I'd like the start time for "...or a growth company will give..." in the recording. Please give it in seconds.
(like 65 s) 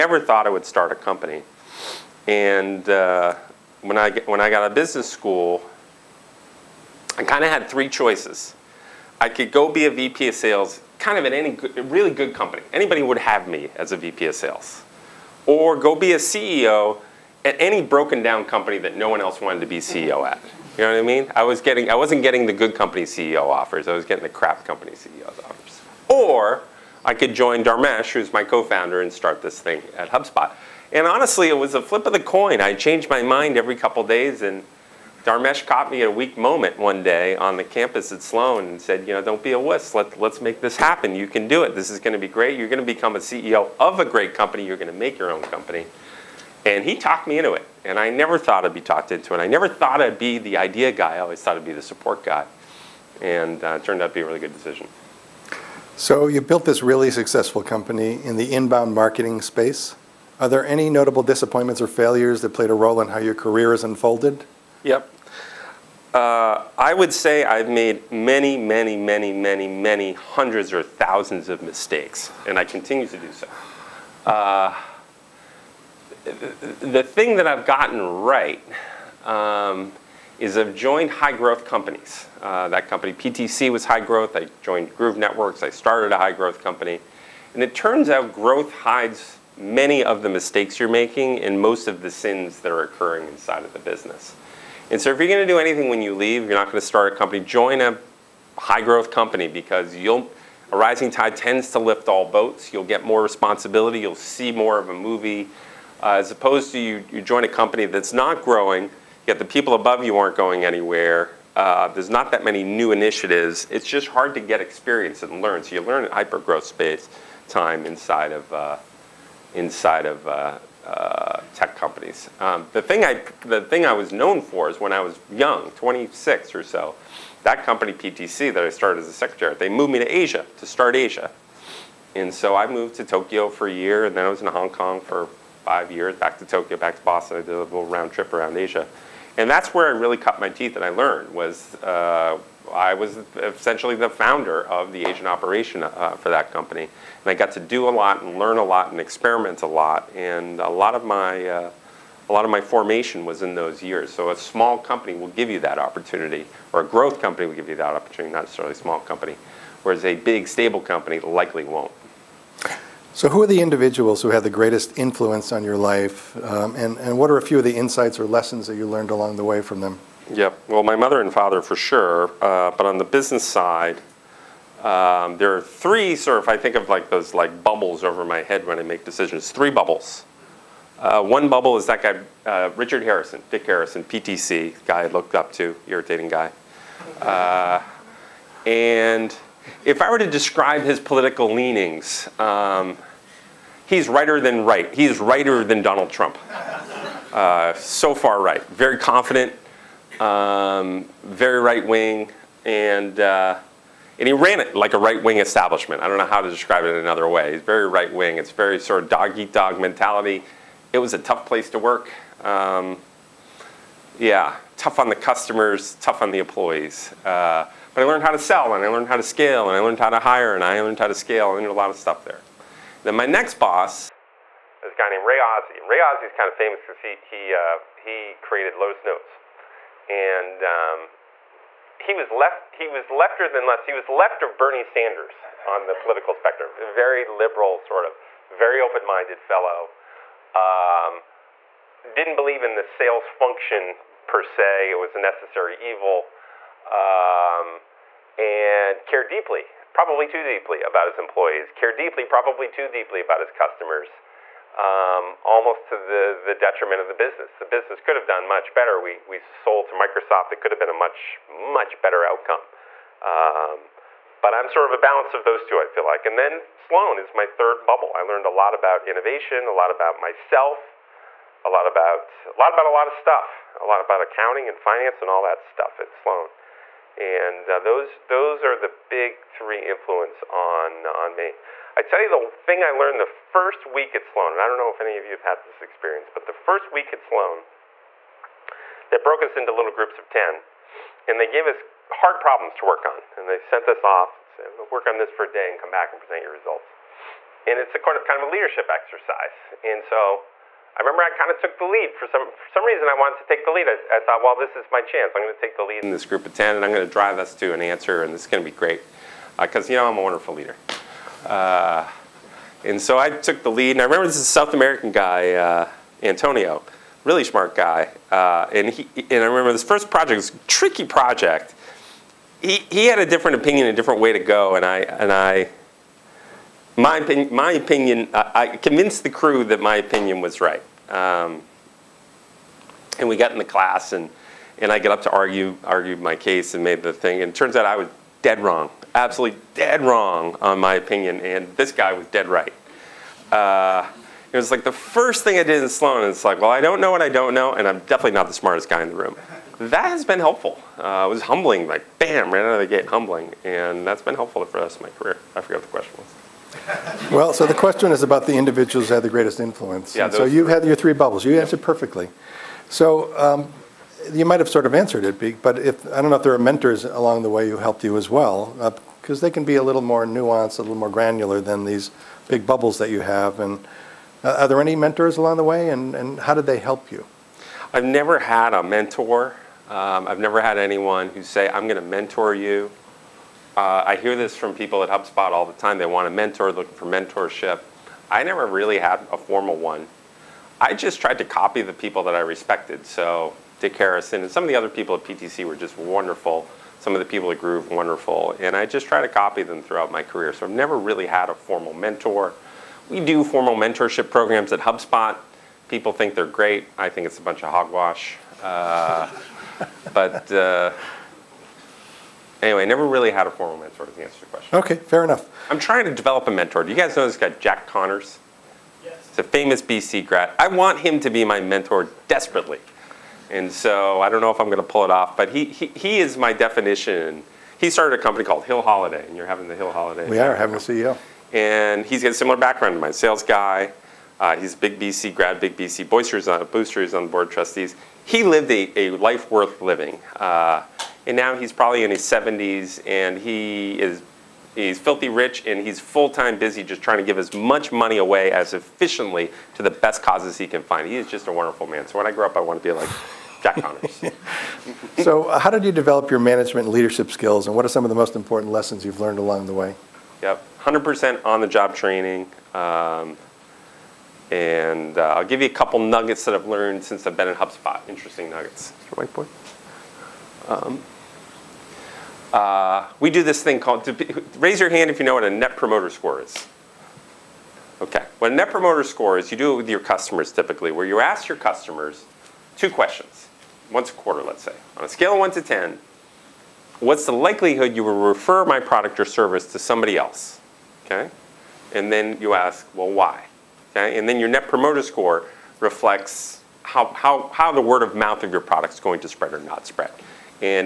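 156 s.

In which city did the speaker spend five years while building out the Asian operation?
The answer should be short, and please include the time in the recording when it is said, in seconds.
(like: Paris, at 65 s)
Hong Kong, at 134 s.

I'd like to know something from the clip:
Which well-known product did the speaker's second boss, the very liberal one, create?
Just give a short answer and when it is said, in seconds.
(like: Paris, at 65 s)
Lotus Notes, at 228 s.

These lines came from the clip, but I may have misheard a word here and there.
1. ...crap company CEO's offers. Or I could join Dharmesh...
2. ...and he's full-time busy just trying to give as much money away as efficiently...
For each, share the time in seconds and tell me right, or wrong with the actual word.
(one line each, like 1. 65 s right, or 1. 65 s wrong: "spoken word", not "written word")
1. 24 s right
2. 445 s right.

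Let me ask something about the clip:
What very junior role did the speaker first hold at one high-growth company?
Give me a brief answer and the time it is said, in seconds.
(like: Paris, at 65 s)
secretary, at 129 s.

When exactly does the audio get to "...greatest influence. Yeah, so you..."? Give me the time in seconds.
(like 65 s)
359 s.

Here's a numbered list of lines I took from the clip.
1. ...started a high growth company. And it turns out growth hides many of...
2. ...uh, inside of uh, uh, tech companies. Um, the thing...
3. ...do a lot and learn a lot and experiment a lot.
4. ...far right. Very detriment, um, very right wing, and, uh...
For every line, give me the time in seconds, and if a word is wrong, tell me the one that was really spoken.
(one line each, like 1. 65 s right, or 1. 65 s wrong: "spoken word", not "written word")
1. 85 s right
2. 118 s right
3. 147 s right
4. 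198 s wrong: "confident", not "detriment".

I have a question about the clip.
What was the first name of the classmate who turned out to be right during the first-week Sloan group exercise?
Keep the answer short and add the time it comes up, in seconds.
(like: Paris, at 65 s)
Antonio, at 316 s.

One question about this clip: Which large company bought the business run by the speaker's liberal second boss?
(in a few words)
Microsoft.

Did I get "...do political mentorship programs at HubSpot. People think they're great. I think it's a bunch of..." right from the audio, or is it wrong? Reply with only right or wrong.
wrong.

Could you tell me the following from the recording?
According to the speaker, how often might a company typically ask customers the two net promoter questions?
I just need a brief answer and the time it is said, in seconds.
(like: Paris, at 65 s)
once a quarter, at 483 s.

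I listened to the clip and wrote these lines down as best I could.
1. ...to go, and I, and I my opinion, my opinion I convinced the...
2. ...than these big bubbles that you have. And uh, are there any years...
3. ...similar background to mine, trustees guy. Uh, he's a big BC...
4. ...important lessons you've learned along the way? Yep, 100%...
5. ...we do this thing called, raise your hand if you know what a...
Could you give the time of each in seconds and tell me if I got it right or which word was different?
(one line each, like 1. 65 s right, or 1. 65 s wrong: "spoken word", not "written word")
1. 324 s right
2. 371 s wrong: "mentors", not "years"
3. 432 s wrong: "sales", not "trustees"
4. 458 s right
5. 473 s right.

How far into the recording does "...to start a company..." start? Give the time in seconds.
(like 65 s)
96 s.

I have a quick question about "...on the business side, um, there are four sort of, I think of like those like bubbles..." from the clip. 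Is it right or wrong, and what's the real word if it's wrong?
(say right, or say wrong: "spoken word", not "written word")
wrong: "three", not "four".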